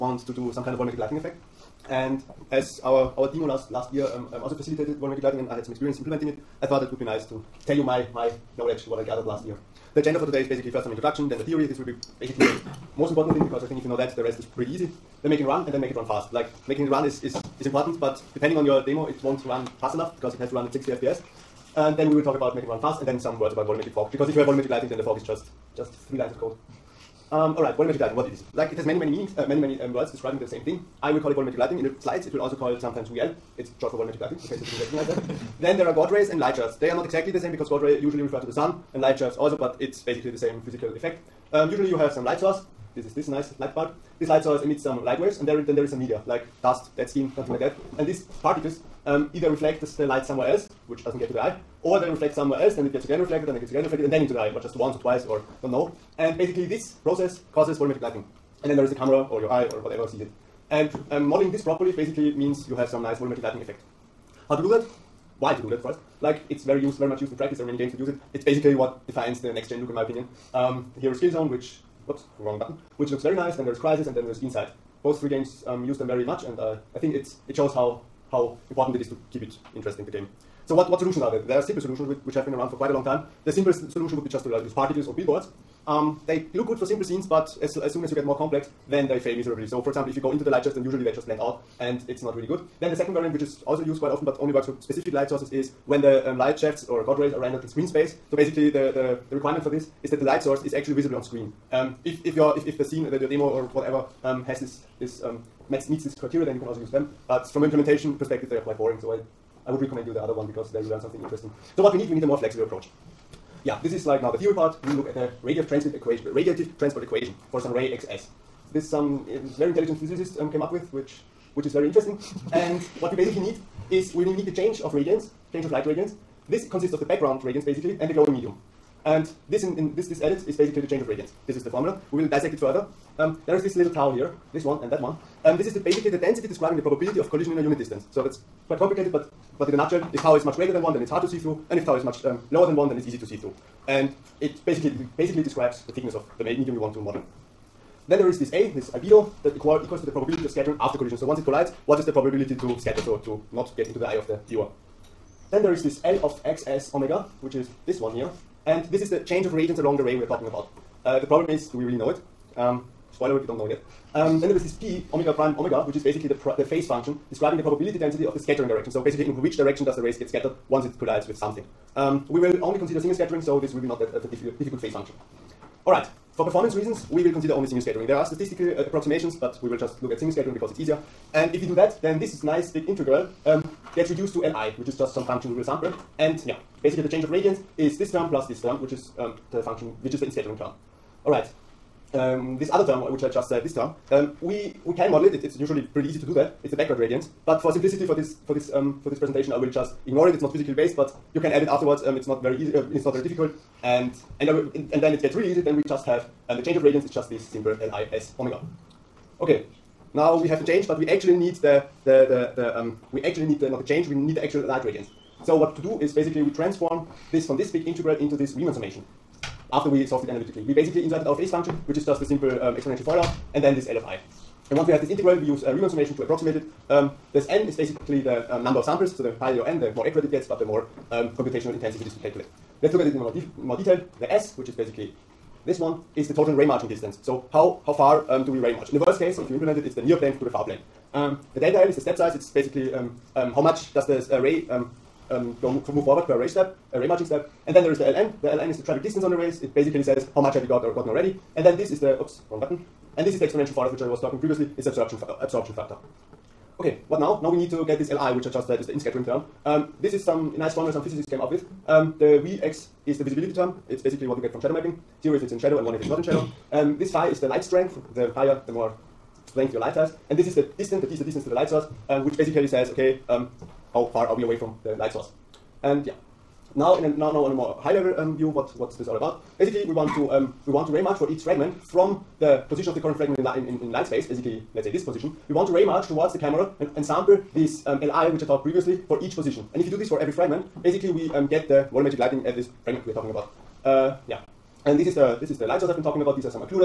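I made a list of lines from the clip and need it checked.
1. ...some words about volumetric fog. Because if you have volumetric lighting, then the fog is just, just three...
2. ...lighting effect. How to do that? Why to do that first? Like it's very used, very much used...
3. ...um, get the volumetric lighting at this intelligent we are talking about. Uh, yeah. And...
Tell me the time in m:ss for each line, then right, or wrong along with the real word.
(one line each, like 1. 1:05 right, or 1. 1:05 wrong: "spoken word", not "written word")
1. 0:23 right
2. 1:03 right
3. 4:51 wrong: "fragment", not "intelligent".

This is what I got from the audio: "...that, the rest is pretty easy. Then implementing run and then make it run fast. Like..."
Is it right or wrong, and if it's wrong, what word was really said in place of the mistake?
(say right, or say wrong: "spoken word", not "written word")
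wrong: "making", not "implementing".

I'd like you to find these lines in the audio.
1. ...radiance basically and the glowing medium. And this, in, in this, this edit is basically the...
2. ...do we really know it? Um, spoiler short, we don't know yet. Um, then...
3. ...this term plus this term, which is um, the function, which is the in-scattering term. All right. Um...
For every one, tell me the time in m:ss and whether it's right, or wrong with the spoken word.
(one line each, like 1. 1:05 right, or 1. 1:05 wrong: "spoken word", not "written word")
1. 2:07 right
2. 2:41 wrong: "alert", not "short"
3. 3:07 right.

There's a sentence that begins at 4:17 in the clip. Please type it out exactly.
Now we need to get this Li, which I just said is the in-scattering term.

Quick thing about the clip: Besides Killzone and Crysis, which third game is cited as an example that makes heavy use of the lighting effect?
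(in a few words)
Inside.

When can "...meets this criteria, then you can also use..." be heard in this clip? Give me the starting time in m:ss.
1:45.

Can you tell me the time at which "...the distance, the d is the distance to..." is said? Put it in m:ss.
4:30.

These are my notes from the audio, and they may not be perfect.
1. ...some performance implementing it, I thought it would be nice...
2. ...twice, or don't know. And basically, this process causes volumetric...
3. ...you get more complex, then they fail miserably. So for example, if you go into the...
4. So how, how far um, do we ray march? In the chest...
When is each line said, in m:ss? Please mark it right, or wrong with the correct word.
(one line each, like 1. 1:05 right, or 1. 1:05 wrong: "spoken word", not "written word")
1. 0:05 wrong: "experience", not "performance"
2. 0:55 right
3. 1:28 right
4. 3:57 wrong: "worst", not "chest".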